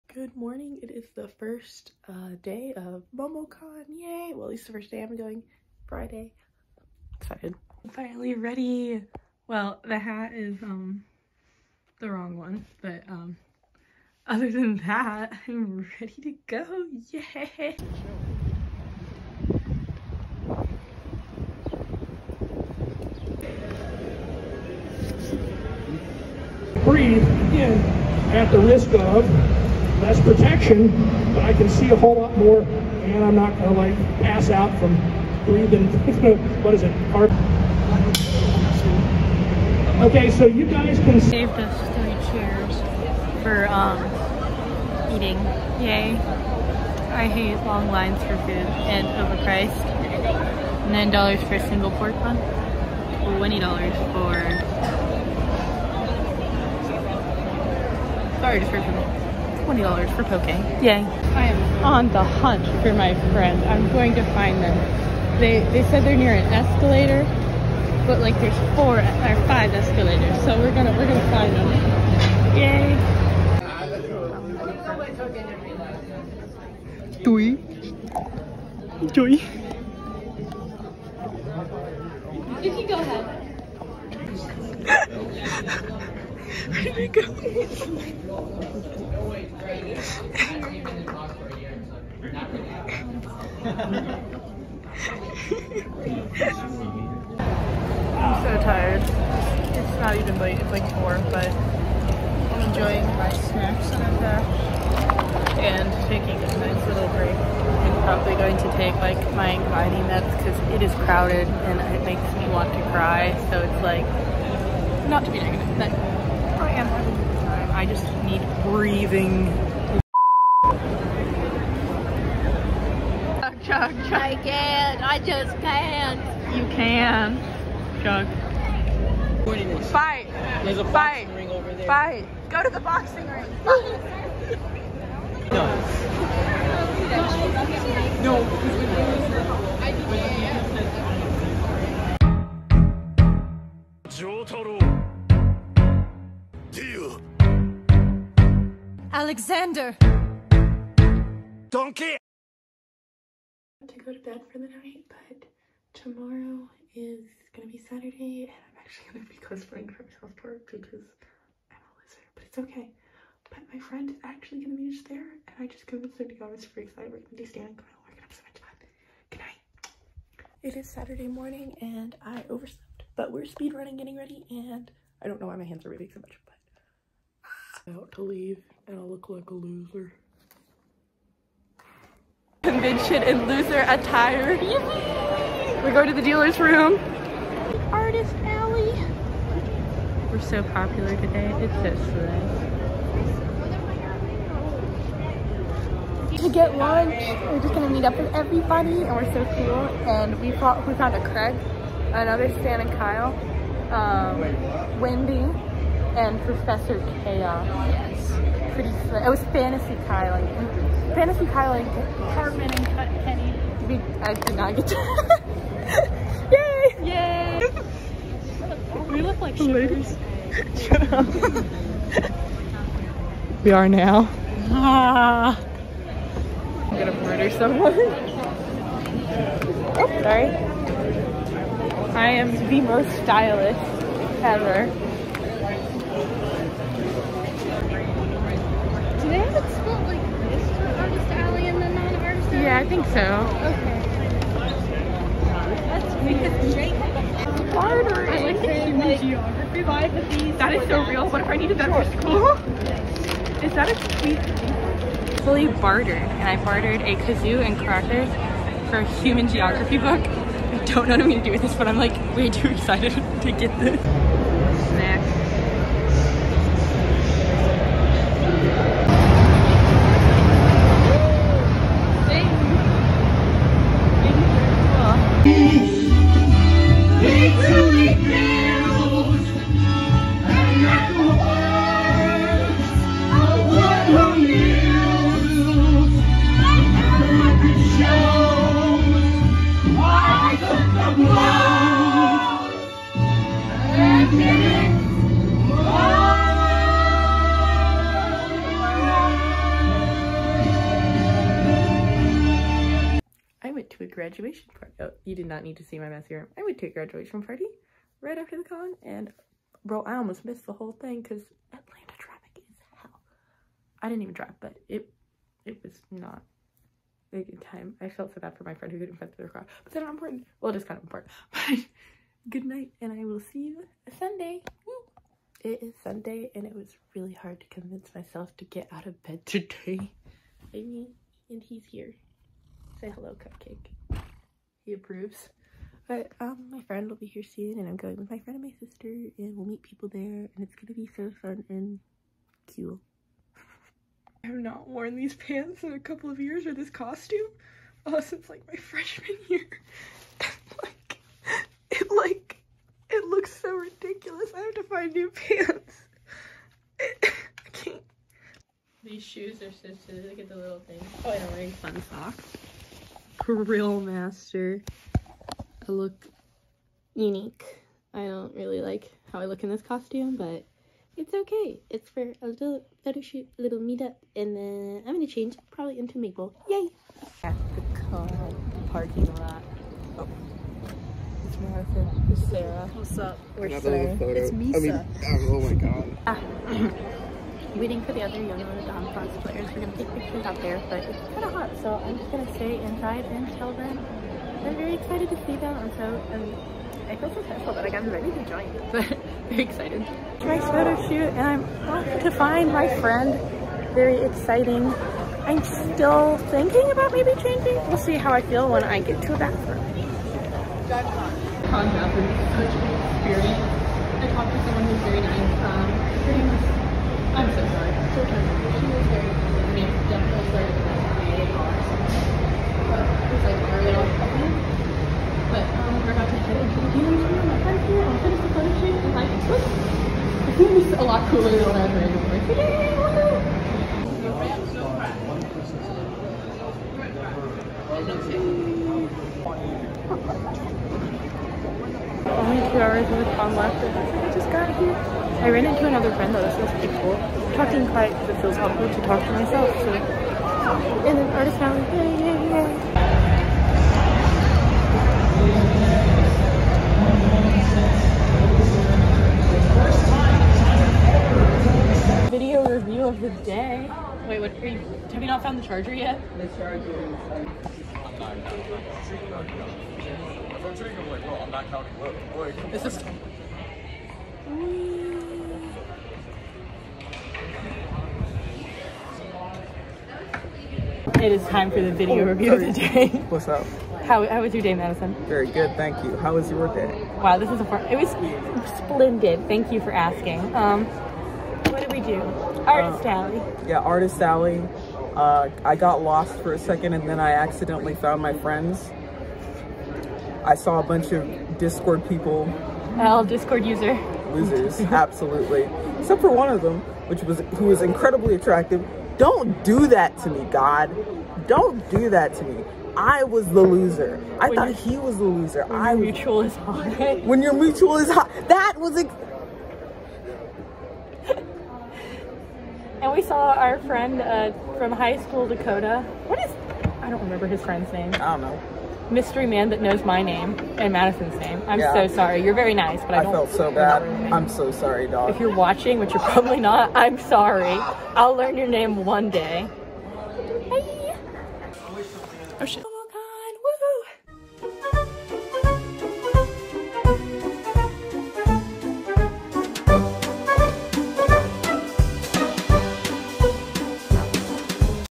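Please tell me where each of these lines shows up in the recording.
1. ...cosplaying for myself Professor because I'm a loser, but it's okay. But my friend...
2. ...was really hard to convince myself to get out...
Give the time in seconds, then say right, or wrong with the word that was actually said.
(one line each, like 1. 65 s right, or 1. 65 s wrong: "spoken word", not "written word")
1. 159 s wrong: "Park", not "Professor"
2. 326 s right.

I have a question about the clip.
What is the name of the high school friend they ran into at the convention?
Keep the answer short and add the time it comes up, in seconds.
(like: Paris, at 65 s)
Dakota, at 525 s.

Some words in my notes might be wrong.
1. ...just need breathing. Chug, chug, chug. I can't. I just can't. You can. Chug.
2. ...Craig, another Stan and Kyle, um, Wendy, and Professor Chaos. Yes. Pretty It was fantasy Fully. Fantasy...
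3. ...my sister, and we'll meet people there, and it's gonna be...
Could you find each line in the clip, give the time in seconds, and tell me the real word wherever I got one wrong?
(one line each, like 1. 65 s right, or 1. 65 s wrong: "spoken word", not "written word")
1. 117 s right
2. 201 s wrong: "Kylie", not "Fully"
3. 338 s right.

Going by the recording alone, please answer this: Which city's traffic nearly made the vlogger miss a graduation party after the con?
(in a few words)
Atlanta.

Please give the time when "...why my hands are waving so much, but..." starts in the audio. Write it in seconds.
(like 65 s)
175 s.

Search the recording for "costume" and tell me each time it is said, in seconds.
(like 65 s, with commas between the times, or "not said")
346 s, 369 s.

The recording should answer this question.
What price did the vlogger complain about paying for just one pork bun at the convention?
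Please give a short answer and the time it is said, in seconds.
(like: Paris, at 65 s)
$9, at 50 s.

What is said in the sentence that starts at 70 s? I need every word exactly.
So we're gonna, we're gonna find them.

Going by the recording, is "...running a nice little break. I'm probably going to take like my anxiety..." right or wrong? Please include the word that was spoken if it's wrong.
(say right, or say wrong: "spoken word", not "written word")
wrong: "taking", not "running".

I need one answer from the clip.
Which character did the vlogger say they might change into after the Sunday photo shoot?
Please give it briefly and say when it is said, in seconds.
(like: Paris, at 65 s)
Mabel, at 376 s.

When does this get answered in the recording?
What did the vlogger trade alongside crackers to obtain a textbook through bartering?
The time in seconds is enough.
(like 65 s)
257 s.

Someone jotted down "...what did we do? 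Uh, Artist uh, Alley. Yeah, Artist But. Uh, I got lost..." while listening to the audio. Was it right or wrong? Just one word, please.
wrong.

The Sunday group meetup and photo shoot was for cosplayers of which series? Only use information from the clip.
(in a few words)
Yona of the Dawn.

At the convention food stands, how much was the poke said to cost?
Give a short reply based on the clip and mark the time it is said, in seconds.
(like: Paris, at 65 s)
$20, at 59 s.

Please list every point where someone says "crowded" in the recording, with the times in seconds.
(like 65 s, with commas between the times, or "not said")
111 s.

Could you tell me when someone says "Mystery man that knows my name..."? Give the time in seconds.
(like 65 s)
529 s.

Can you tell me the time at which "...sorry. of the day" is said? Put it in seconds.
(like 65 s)
482 s.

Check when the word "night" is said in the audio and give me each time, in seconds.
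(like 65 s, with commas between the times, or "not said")
154 s, 169 s, 322 s.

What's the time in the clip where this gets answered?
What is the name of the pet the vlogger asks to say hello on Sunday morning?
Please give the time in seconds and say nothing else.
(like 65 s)
333 s.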